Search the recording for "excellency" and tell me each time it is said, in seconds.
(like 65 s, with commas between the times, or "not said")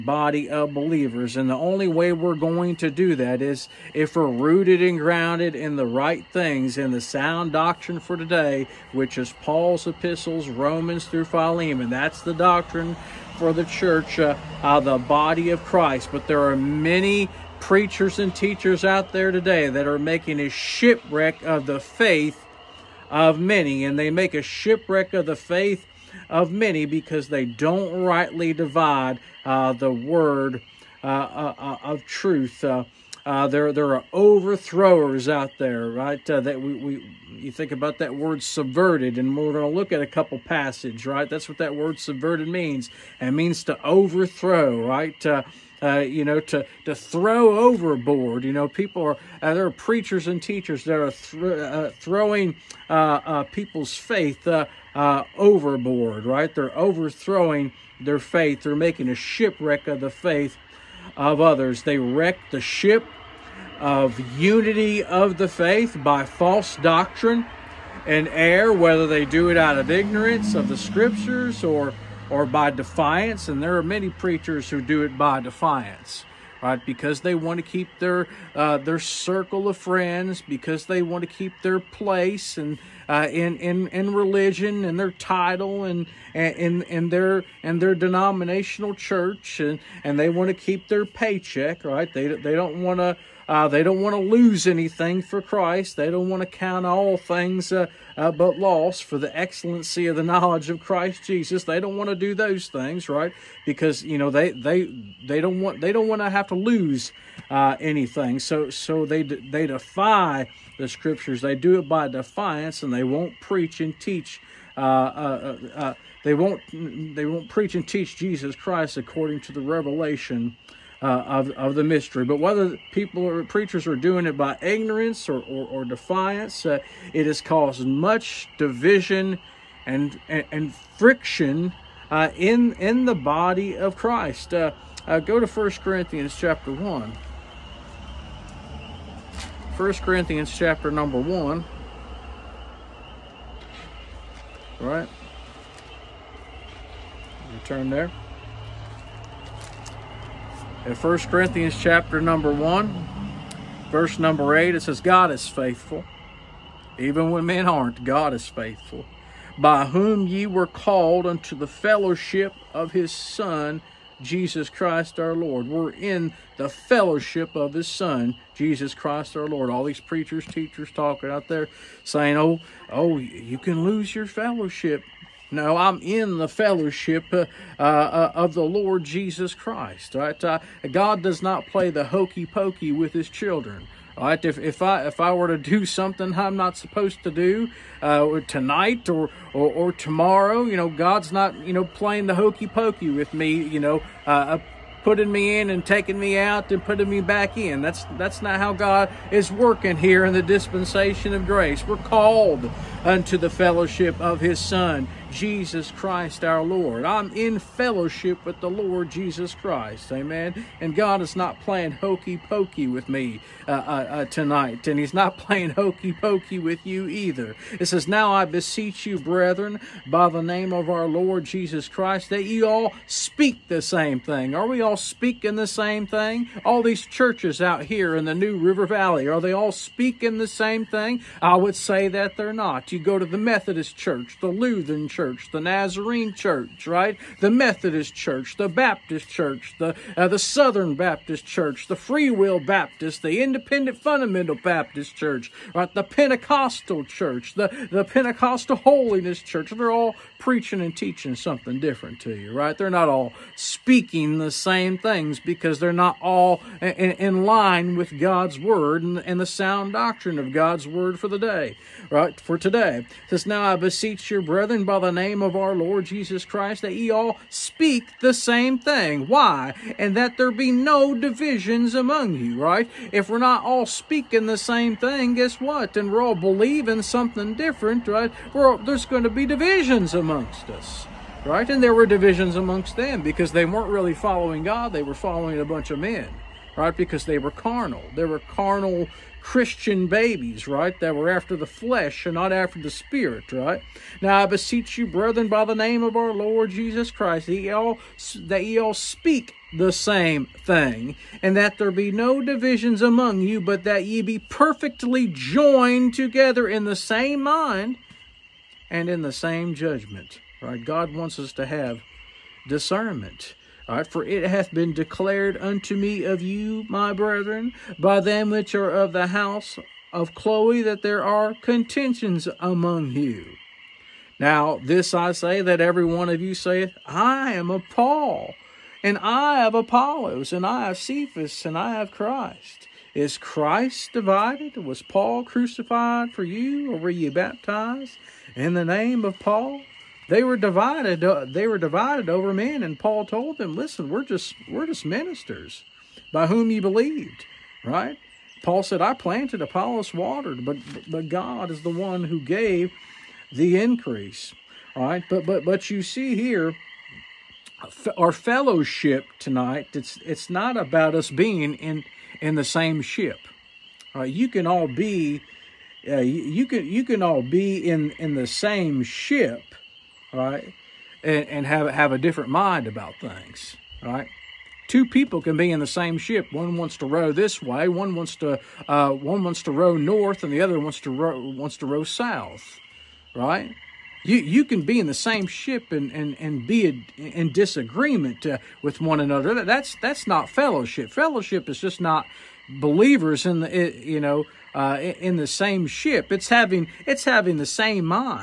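99 s.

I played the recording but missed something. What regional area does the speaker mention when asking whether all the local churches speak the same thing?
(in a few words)
New River Valley.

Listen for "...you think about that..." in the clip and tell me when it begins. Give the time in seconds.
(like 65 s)
37 s.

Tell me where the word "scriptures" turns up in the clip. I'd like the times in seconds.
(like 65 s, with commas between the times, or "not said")
70 s, 110 s.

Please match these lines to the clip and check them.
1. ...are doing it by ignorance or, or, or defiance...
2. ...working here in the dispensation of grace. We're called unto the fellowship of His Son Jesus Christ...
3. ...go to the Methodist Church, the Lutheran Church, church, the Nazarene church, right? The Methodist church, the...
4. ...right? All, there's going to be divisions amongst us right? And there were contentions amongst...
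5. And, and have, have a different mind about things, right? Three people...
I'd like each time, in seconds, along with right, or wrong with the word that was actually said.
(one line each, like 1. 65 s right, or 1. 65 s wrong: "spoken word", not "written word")
1. 123 s right
2. 199 s right
3. 232 s right
4. 278 s wrong: "divisions", not "contentions"
5. 371 s wrong: "Two", not "Three".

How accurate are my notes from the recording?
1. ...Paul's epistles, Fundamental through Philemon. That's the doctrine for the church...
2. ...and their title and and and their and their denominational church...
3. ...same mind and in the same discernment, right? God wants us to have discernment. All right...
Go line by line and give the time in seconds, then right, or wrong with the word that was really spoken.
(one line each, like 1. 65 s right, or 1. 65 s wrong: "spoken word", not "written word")
1. 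9 s wrong: "Romans", not "Fundamental"
2. 84 s right
3. 306 s wrong: "judgment", not "discernment".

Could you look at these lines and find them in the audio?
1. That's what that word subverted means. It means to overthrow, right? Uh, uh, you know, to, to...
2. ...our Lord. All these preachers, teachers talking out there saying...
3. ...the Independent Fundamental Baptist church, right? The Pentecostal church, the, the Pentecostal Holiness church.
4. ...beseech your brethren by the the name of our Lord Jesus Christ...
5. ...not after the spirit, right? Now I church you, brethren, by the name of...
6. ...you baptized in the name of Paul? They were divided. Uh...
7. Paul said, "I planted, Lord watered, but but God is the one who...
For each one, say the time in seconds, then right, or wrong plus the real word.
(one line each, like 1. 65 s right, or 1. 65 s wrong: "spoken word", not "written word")
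1. 41 s right
2. 169 s right
3. 243 s right
4. 263 s right
5. 292 s wrong: "beseech", not "church"
6. 337 s right
7. 348 s wrong: "Apollos", not "Lord".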